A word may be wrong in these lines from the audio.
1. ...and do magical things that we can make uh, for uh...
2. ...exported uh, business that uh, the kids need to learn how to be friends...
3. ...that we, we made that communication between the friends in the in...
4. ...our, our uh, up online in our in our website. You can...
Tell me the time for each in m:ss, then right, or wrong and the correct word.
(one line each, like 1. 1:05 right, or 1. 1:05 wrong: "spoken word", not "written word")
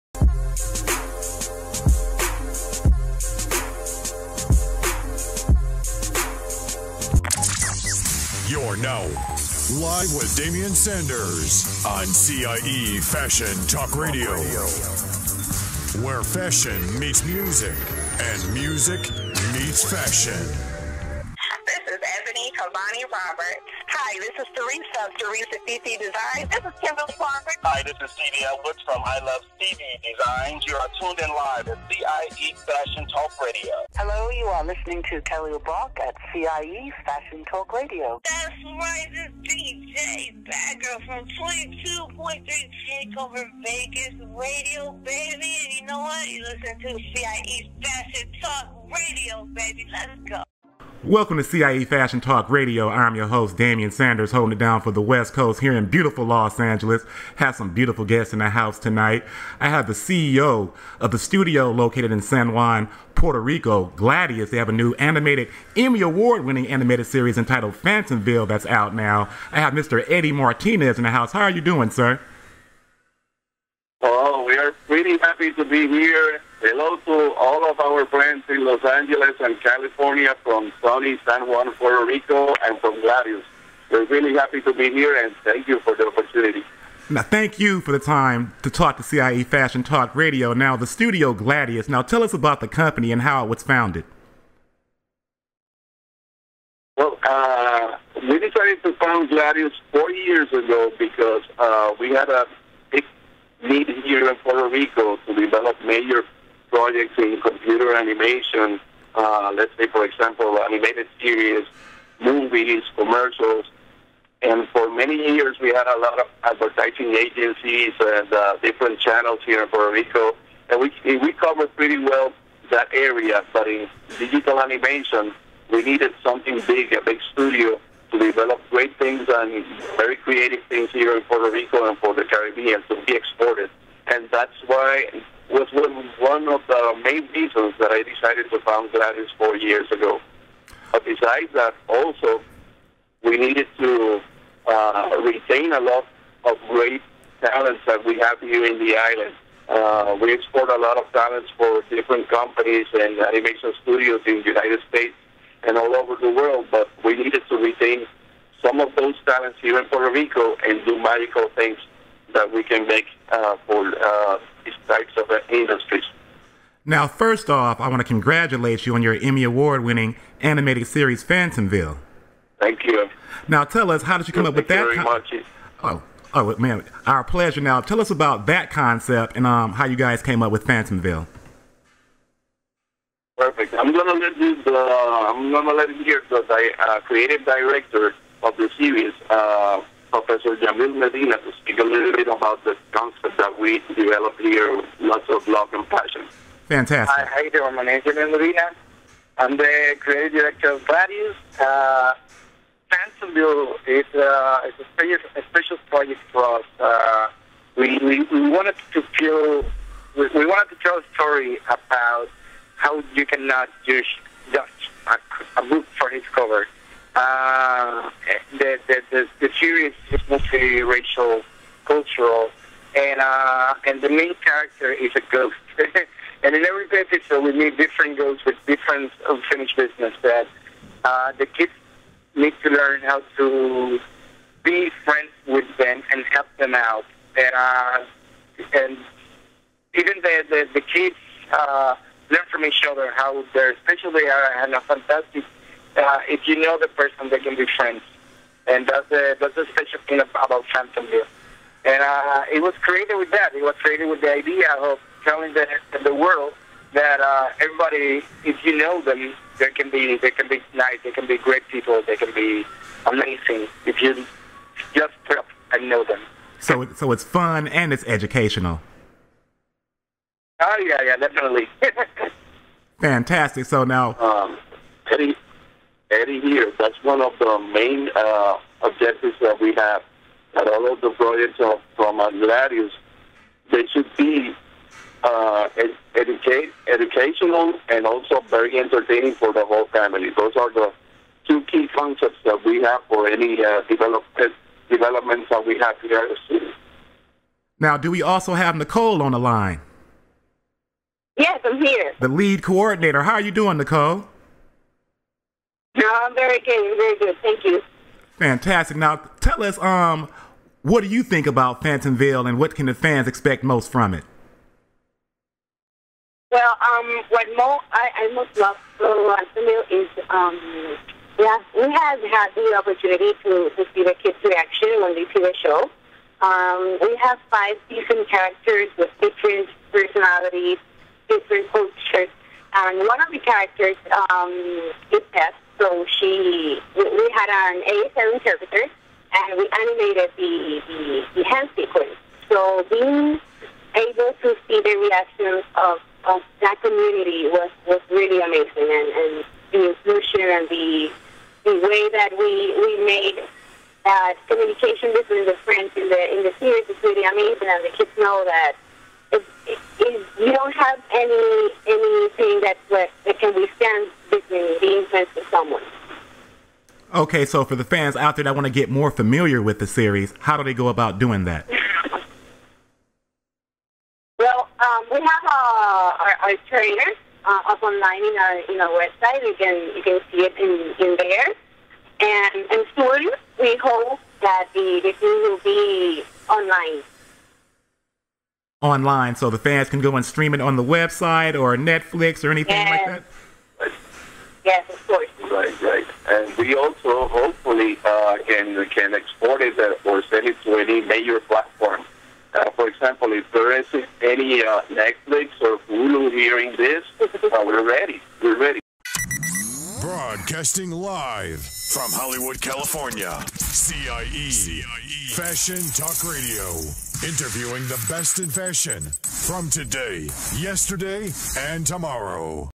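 1. 2:40 right
2. 3:49 wrong: "unfinished", not "exported"
3. 5:52 right
4. 6:16 right.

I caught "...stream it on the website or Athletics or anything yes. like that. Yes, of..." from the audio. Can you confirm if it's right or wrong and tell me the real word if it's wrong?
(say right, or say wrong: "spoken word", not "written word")
wrong: "Netflix", not "Athletics".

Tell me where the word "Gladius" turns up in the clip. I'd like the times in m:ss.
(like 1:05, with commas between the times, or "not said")
1:03, 1:23, 1:31, 1:39, 2:18, 3:20.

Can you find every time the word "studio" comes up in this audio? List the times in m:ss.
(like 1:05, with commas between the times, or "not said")
1:01, 1:30, 2:07, 2:33.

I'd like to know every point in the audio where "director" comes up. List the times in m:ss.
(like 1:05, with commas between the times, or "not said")
3:07, 3:20.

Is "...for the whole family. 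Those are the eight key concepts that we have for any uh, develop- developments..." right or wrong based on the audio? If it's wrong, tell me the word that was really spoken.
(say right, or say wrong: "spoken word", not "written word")
wrong: "two", not "eight".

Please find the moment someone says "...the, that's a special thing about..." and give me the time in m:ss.
4:09.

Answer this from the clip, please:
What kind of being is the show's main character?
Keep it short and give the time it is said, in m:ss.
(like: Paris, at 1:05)
A ghost, at 3:45.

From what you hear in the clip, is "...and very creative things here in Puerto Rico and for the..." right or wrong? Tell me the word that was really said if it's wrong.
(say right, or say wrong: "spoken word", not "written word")
right.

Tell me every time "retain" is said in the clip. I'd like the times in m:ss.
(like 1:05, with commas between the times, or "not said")
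2:25, 2:37.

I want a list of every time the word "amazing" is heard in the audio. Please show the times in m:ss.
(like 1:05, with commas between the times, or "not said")
4:23, 5:48, 5:57.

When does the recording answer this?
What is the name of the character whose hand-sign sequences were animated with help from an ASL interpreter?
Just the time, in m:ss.
5:35.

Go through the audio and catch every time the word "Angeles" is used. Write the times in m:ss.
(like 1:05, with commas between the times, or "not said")
0:56, 1:18.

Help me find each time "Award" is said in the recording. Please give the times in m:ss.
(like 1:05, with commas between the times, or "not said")
1:06, 2:49.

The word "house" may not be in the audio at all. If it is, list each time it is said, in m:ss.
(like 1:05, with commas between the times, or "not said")
0:58, 1:11.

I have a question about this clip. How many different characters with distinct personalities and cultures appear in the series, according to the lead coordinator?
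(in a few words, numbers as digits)
5.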